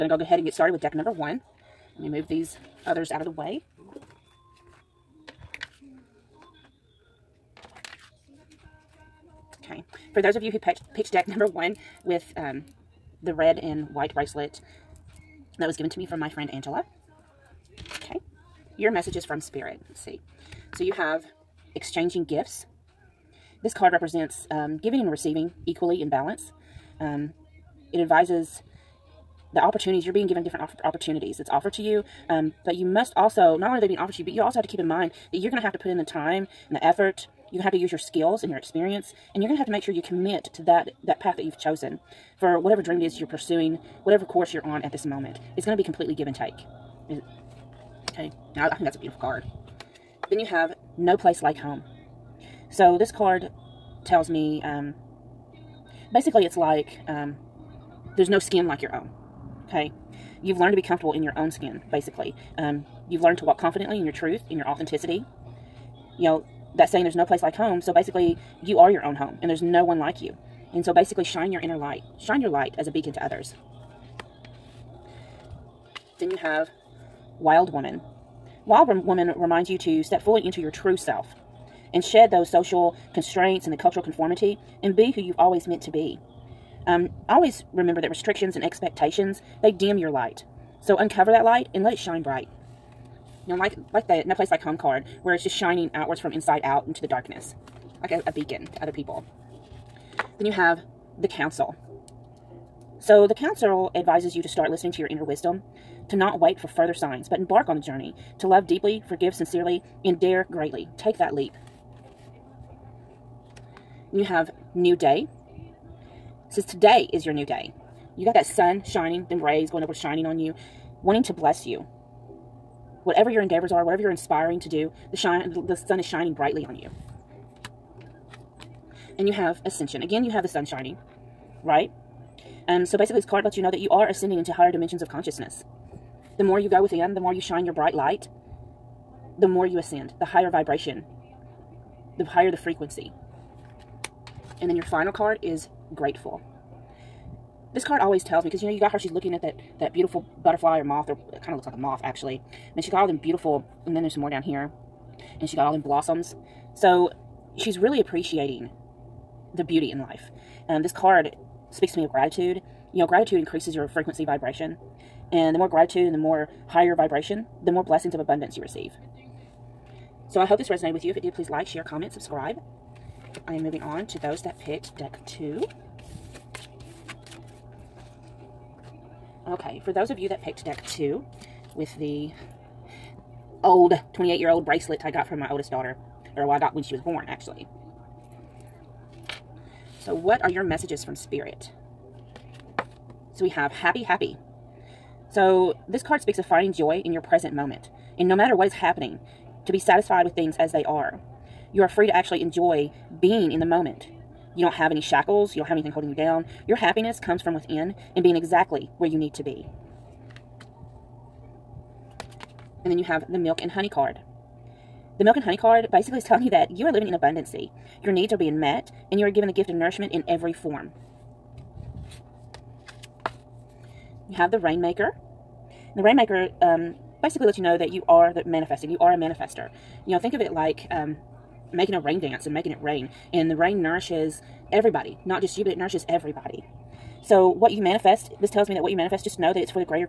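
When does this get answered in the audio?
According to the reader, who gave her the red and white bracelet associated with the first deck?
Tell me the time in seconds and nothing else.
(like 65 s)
16 s.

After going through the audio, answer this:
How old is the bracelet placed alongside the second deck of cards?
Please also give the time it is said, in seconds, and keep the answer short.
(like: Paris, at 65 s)
28 years old, at 184 s.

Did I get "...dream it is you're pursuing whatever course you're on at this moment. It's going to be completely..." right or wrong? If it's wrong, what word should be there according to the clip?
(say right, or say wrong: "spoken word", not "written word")
right.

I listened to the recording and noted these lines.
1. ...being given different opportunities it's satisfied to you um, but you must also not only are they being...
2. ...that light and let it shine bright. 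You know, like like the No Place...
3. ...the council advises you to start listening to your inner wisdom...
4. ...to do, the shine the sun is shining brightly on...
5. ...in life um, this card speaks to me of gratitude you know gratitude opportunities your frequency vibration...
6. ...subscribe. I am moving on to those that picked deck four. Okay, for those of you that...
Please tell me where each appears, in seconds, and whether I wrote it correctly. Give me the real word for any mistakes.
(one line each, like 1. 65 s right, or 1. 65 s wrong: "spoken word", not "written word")
1. 30 s wrong: "offered", not "satisfied"
2. 91 s right
3. 103 s right
4. 124 s right
5. 159 s wrong: "increases", not "opportunities"
6. 172 s wrong: "two", not "four".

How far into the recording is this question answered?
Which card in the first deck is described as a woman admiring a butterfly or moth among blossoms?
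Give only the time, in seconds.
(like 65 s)
145 s.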